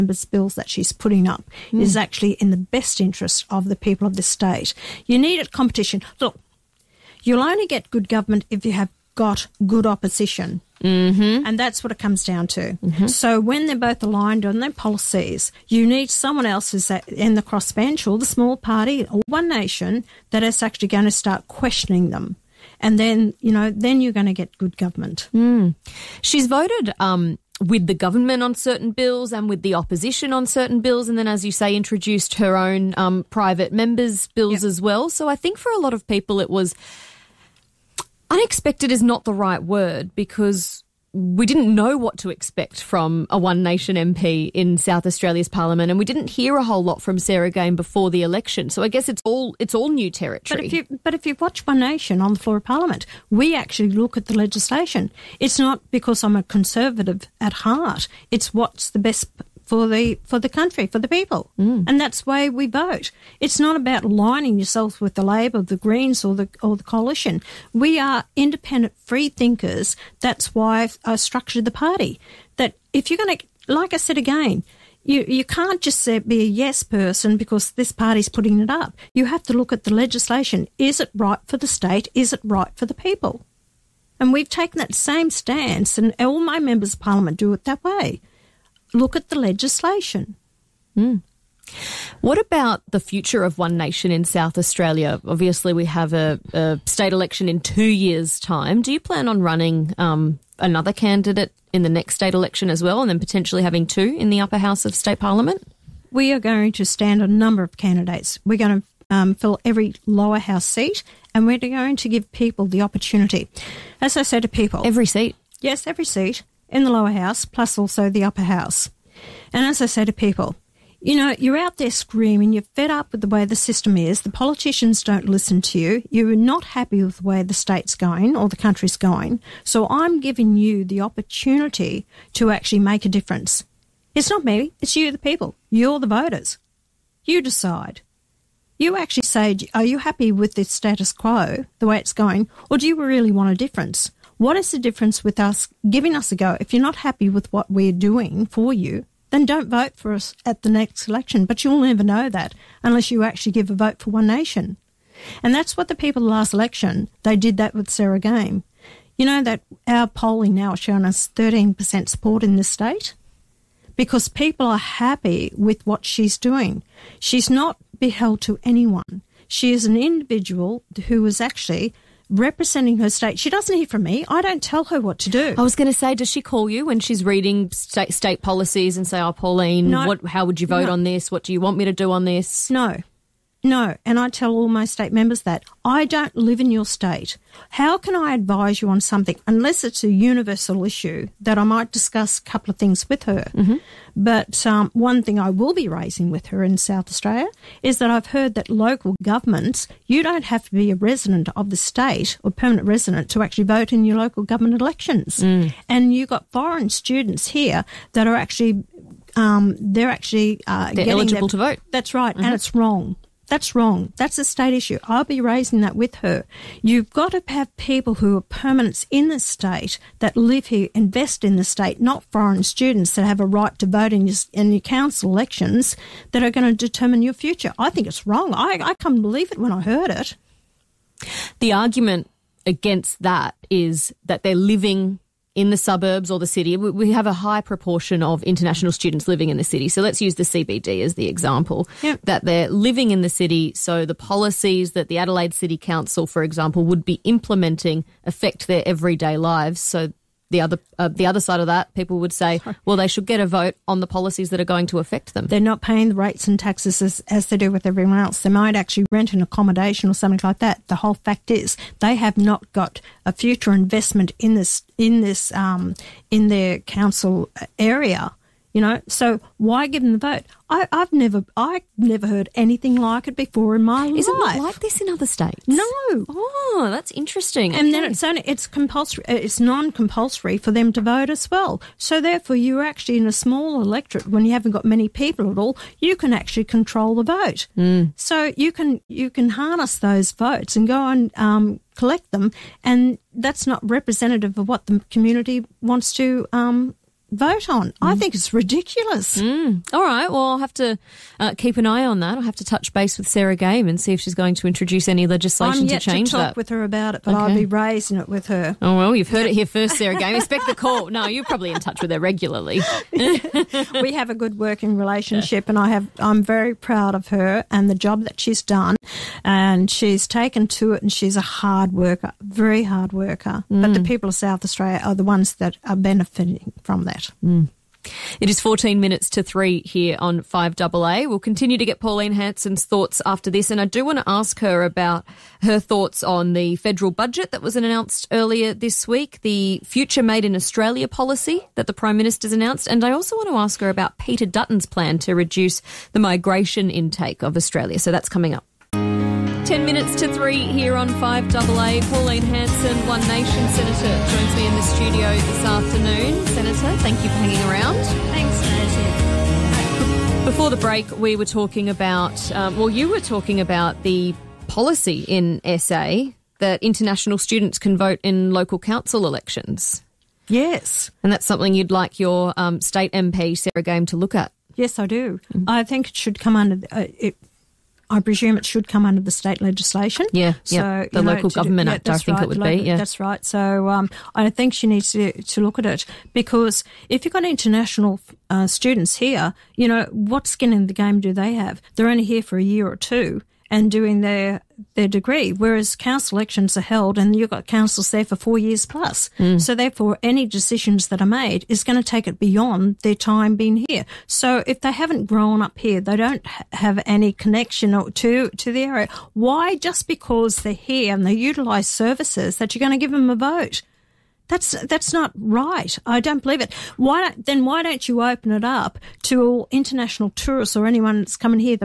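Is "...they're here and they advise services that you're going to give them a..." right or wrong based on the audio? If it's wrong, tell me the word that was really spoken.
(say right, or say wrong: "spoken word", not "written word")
wrong: "utilise", not "advise".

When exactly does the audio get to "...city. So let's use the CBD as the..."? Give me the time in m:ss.
3:59.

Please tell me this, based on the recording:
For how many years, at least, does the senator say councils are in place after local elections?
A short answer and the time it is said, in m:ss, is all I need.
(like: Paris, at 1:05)
4 years, at 6:38.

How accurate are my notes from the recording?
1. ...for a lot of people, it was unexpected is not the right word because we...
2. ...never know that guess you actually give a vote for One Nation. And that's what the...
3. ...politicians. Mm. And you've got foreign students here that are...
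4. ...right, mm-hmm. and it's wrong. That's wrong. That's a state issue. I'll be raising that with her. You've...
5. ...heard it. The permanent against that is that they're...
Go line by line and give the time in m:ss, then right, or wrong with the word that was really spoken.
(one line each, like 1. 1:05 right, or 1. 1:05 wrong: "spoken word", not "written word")
1. 0:35 right
2. 2:31 wrong: "unless", not "guess"
3. 3:24 wrong: "elections", not "politicians"
4. 3:32 right
5. 3:49 wrong: "argument", not "permanent".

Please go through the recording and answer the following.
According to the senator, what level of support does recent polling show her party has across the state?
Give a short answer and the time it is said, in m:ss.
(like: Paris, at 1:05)
13%, at 2:41.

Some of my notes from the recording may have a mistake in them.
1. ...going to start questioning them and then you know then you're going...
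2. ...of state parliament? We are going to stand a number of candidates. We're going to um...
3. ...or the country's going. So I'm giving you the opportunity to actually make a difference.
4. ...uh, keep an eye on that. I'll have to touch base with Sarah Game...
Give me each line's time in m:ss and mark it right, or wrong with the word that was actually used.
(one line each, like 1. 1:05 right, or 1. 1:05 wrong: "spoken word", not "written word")
1. 0:20 right
2. 1:44 right
3. 2:08 right
4. 5:01 right.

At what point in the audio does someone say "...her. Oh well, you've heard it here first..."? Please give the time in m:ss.
5:08.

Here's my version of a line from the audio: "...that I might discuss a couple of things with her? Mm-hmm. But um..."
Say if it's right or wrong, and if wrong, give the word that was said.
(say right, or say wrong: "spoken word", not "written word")
right.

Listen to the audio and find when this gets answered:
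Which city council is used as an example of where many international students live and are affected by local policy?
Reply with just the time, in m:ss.
4:05.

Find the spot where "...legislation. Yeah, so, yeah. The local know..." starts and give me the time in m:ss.
6:19.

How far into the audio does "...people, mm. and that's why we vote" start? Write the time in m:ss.
1:01.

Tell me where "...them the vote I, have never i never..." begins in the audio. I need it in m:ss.
4:30.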